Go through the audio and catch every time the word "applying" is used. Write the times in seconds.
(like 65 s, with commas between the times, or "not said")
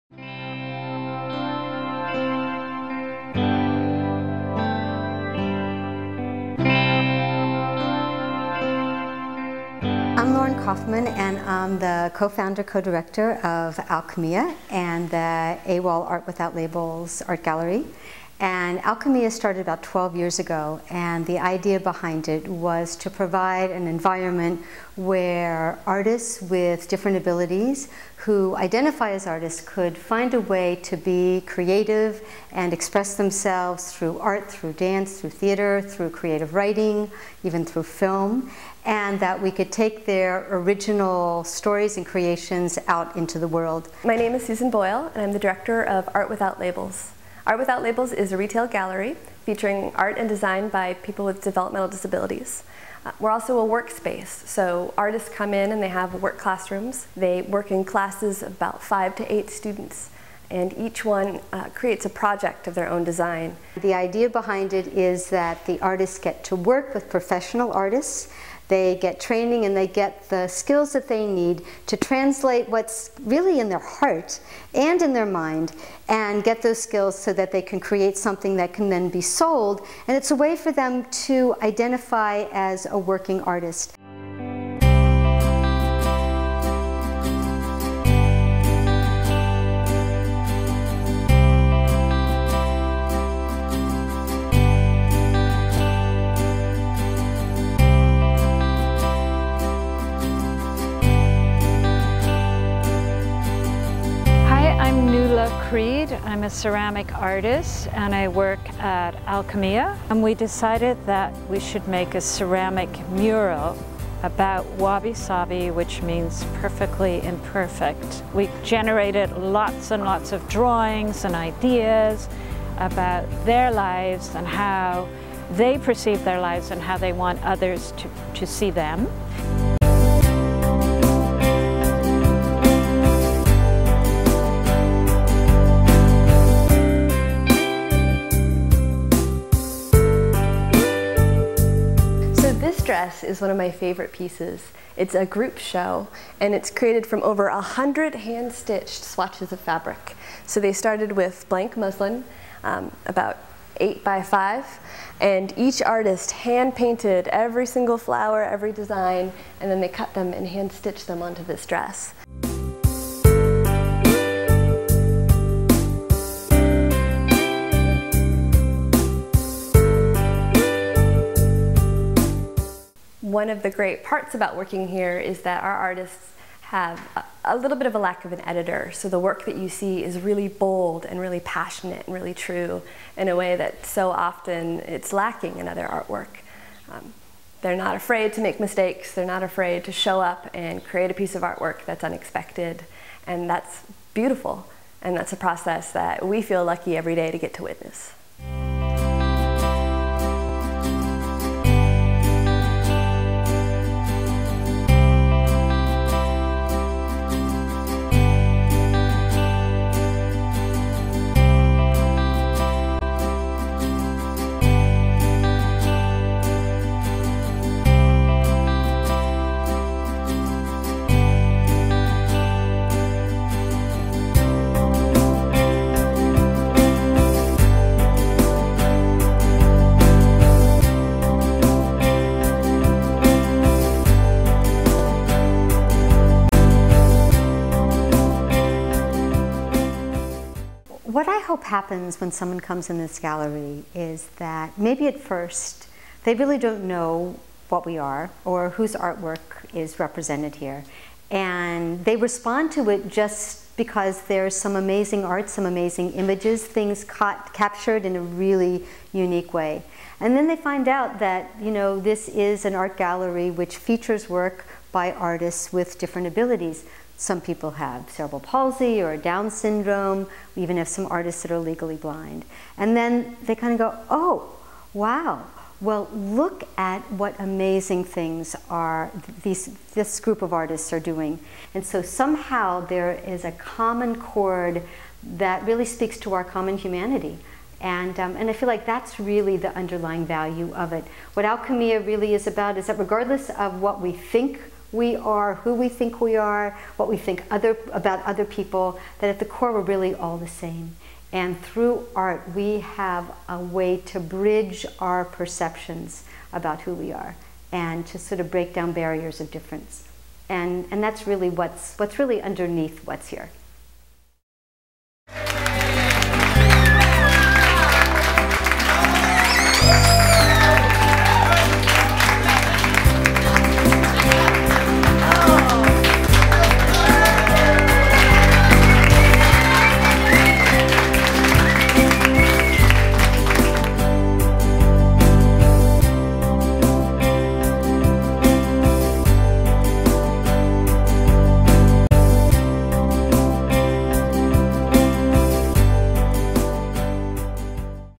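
not said.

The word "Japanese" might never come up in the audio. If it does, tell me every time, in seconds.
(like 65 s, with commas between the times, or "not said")
not said.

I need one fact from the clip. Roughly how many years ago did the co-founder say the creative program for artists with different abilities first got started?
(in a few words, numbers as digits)
12.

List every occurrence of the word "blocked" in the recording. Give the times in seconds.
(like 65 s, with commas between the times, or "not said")
not said.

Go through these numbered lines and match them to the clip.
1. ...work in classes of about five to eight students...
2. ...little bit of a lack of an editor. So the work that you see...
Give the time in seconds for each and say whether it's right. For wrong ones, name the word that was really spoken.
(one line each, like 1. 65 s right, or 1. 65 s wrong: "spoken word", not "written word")
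1. 57 s right
2. 177 s right.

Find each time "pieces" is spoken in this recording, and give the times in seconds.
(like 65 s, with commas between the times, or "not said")
144 s, 191 s.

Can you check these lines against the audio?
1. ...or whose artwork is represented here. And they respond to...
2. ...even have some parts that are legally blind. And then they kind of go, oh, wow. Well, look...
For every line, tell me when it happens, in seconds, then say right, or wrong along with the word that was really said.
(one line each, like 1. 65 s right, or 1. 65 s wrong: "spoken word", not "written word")
1. 248 s right
2. 270 s wrong: "artists", not "parts".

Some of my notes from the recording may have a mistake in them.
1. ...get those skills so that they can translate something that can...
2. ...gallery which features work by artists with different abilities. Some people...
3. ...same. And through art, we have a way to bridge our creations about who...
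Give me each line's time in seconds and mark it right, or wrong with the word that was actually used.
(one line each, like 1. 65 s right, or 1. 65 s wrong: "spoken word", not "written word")
1. 76 s wrong: "create", not "translate"
2. 262 s right
3. 300 s wrong: "perceptions", not "creations".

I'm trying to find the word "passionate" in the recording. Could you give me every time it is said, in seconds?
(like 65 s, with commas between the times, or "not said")
181 s.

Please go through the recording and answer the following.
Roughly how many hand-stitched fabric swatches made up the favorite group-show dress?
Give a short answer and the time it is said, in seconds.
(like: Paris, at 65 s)
over 100, at 147 s.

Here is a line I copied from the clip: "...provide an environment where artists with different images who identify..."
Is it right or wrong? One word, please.
wrong.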